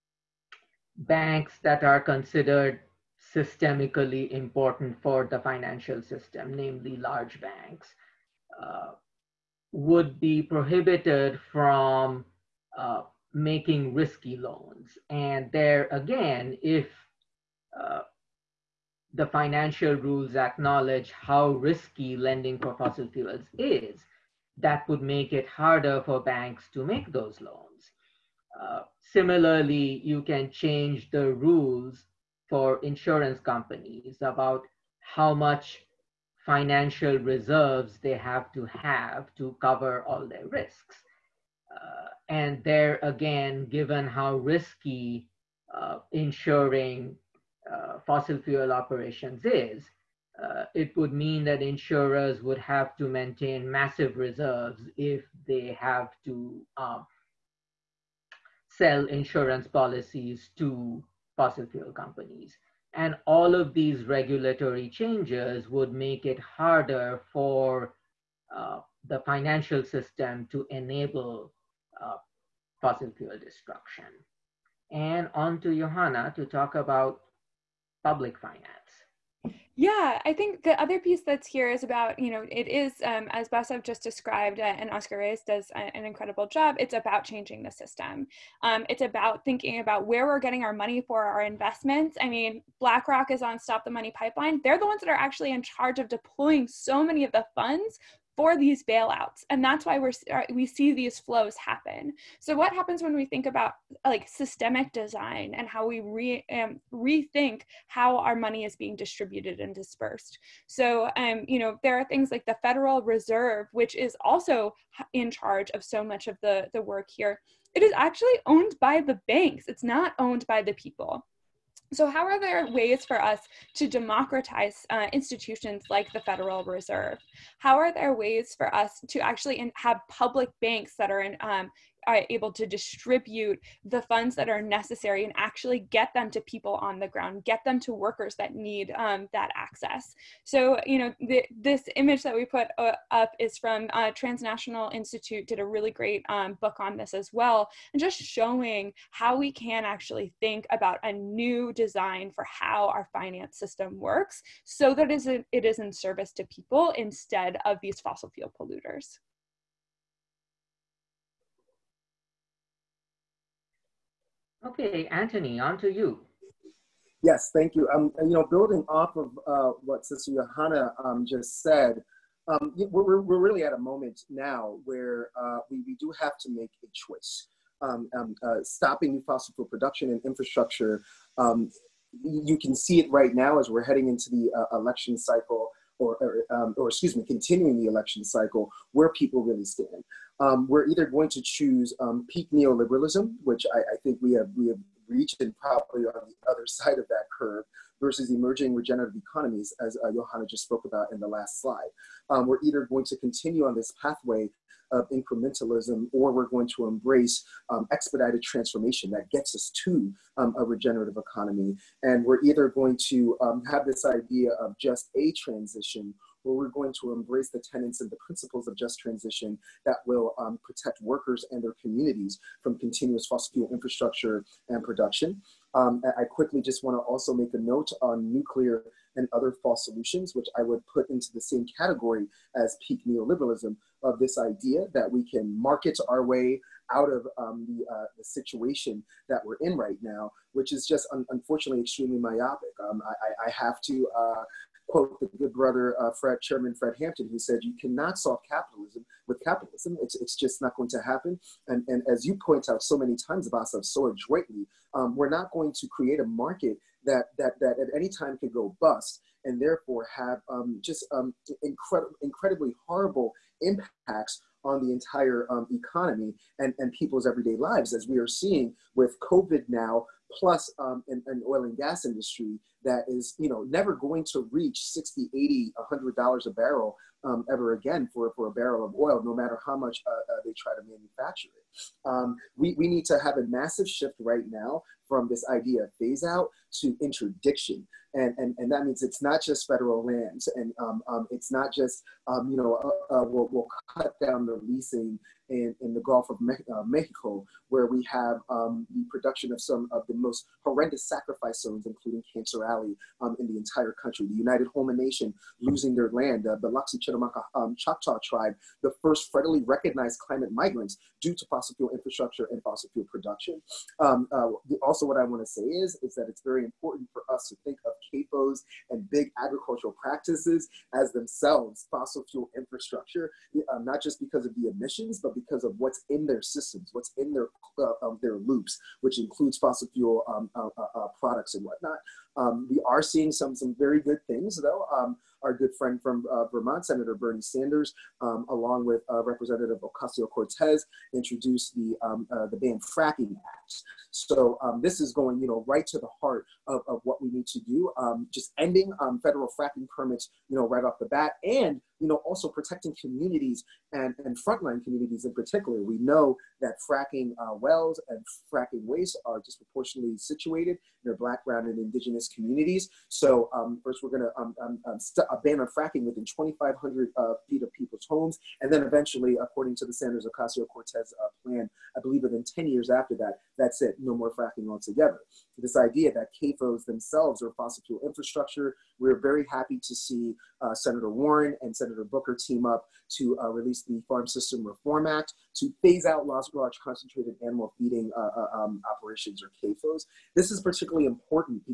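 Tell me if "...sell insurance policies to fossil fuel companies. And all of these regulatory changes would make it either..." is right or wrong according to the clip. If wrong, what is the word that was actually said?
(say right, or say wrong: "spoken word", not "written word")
wrong: "harder", not "either".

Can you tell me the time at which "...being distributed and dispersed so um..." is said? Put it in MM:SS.
01:48.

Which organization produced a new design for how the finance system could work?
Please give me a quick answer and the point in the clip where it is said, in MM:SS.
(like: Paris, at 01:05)
Transnational Institute, at 02:24.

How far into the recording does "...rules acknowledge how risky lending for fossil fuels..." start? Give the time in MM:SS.
00:19.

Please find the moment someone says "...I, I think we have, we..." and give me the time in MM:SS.
03:13.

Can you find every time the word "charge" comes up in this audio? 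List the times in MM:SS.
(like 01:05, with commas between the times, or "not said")
01:35, 01:55.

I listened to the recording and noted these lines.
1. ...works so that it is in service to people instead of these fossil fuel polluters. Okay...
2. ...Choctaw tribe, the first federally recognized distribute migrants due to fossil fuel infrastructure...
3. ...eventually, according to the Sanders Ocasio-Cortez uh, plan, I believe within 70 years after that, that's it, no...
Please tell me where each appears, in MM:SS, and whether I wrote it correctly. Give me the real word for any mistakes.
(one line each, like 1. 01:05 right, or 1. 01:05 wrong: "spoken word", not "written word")
1. 02:33 right
2. 05:07 wrong: "climate", not "distribute"
3. 06:08 wrong: "10", not "70".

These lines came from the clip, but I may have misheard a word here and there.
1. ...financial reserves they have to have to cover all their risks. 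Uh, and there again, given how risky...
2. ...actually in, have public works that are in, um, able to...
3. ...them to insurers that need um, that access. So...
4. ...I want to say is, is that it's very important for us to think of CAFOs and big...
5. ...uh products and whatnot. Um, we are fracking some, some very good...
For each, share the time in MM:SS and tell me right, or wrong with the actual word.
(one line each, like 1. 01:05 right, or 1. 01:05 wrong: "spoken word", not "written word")
1. 00:36 right
2. 02:09 wrong: "banks", not "works"
3. 02:17 wrong: "workers", not "insurers"
4. 05:15 right
5. 05:31 wrong: "seeing", not "fracking".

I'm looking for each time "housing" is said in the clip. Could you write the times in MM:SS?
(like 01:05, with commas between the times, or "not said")
not said.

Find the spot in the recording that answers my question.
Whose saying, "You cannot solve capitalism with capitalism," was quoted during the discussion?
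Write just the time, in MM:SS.
04:06.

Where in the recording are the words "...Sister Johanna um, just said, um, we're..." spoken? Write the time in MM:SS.
02:50.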